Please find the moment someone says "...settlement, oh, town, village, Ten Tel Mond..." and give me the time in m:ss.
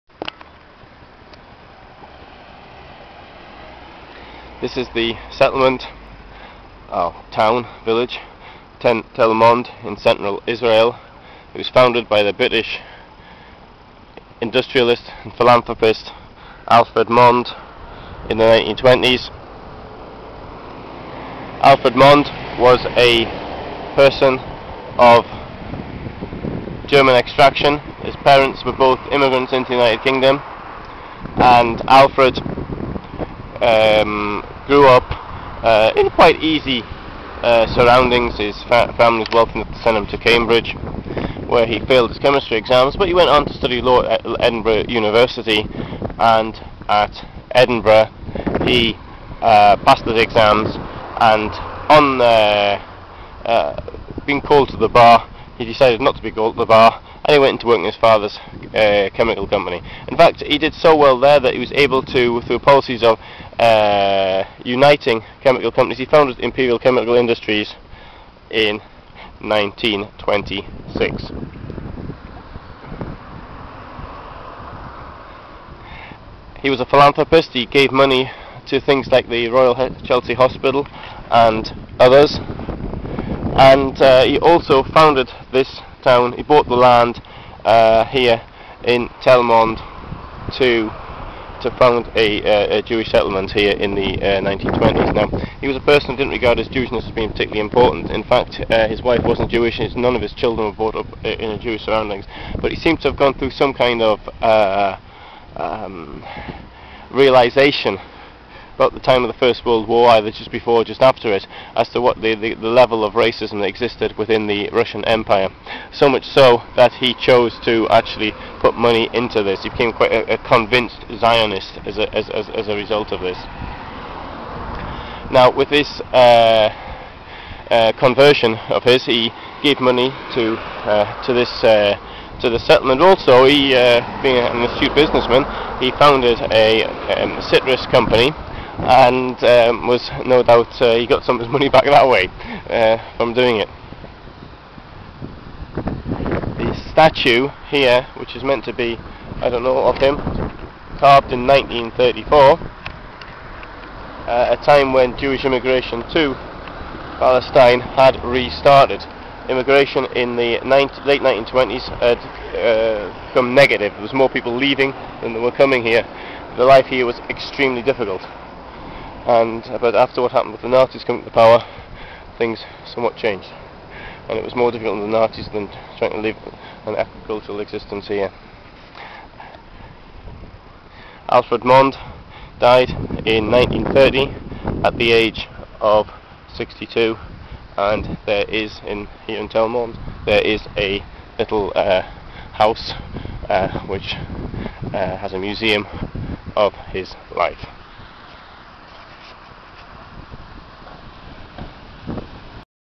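0:05.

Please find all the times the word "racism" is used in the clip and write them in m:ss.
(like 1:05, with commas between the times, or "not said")
1:53.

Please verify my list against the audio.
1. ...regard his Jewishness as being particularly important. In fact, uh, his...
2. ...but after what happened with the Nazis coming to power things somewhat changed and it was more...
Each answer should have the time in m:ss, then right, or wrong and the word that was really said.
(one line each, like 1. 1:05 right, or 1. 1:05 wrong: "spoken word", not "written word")
1. 1:36 right
2. 2:49 right.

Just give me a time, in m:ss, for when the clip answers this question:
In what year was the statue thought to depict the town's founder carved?
2:31.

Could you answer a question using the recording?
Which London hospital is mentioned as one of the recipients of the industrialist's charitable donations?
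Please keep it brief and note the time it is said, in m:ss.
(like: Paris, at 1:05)
Royal Chelsea Hospital, at 1:19.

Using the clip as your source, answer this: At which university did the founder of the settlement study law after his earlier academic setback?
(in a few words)
Edinburgh University.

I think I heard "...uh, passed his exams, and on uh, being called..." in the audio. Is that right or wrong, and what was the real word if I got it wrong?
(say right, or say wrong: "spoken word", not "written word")
right.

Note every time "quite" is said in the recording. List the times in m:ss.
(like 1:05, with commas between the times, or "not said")
0:36, 1:59.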